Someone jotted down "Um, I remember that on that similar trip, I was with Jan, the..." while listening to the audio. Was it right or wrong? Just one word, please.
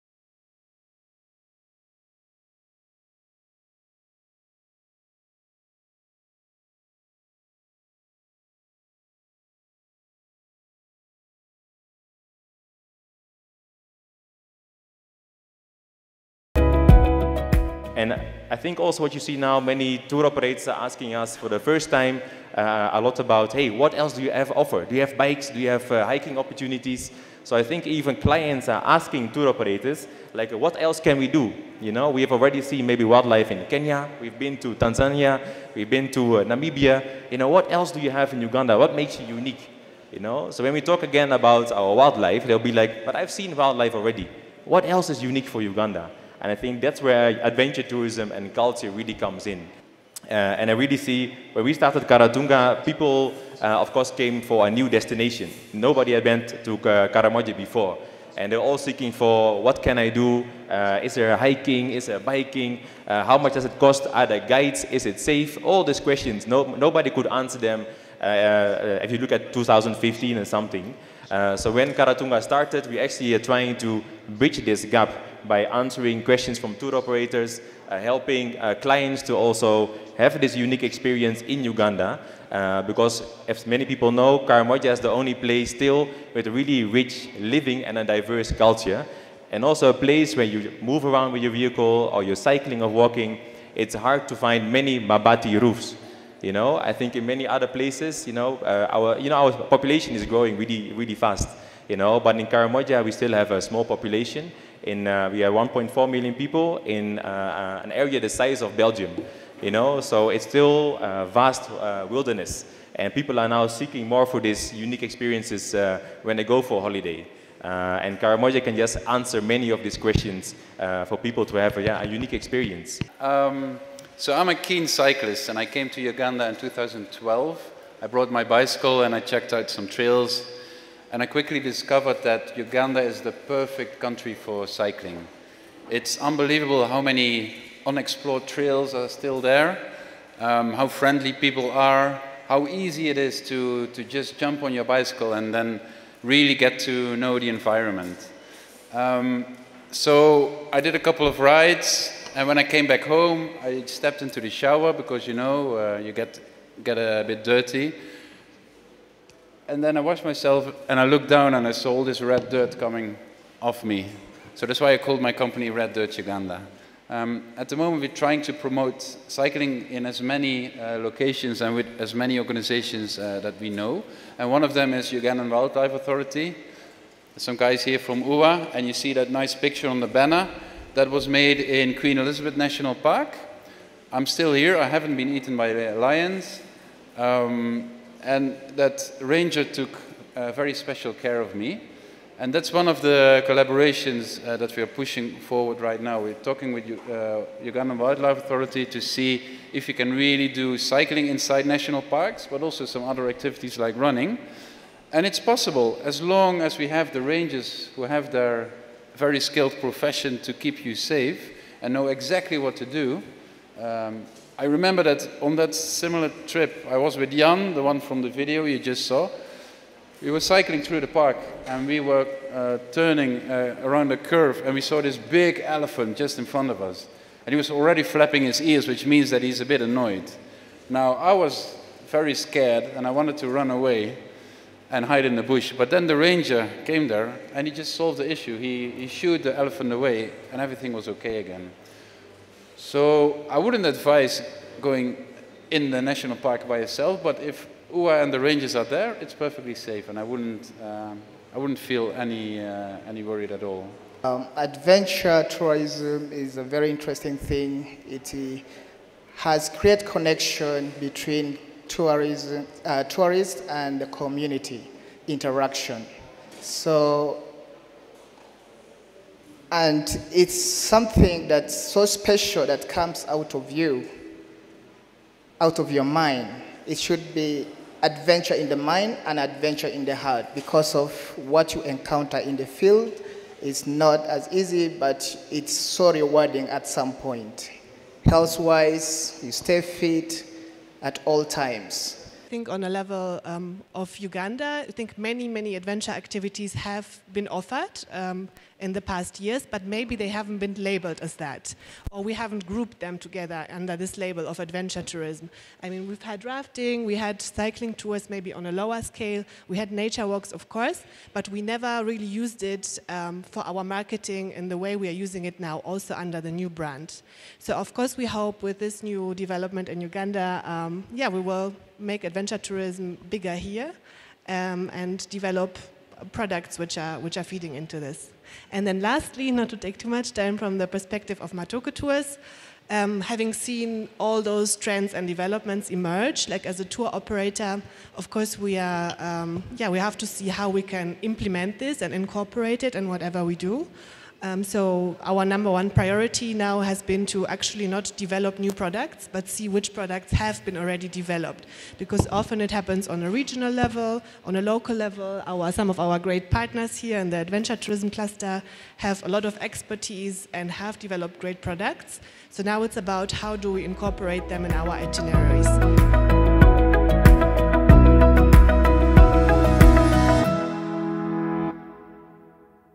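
right.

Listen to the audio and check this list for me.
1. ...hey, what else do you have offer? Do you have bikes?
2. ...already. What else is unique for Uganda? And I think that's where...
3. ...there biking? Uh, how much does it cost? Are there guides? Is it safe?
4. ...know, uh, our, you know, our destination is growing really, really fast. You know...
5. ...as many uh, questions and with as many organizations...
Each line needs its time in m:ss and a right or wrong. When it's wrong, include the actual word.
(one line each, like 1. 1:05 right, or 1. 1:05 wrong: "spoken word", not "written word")
1. 0:23 right
2. 0:43 right
3. 1:02 right
4. 1:38 wrong: "population", not "destination"
5. 2:50 wrong: "locations", not "questions".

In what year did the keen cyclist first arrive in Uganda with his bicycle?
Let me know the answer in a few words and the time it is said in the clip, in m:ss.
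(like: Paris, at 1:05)
2012, at 2:06.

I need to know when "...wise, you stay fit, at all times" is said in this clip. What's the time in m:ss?
4:48.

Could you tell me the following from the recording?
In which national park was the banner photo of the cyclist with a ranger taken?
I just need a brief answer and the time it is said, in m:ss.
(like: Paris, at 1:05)
Queen Elizabeth National Park, at 3:01.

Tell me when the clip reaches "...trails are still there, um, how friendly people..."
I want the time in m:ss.
2:18.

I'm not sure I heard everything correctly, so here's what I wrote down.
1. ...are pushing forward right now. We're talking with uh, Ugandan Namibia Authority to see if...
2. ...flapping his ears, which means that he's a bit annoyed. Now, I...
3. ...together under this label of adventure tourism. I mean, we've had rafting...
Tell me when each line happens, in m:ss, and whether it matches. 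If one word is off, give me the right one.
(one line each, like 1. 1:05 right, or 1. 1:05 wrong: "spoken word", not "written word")
1. 3:14 wrong: "Wildlife", not "Namibia"
2. 3:48 right
3. 5:03 right.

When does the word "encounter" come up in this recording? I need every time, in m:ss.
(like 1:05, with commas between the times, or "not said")
4:41.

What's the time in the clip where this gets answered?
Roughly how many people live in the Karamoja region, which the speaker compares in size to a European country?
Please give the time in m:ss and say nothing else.
1:45.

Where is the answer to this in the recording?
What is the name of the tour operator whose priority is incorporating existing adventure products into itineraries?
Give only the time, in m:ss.
5:31.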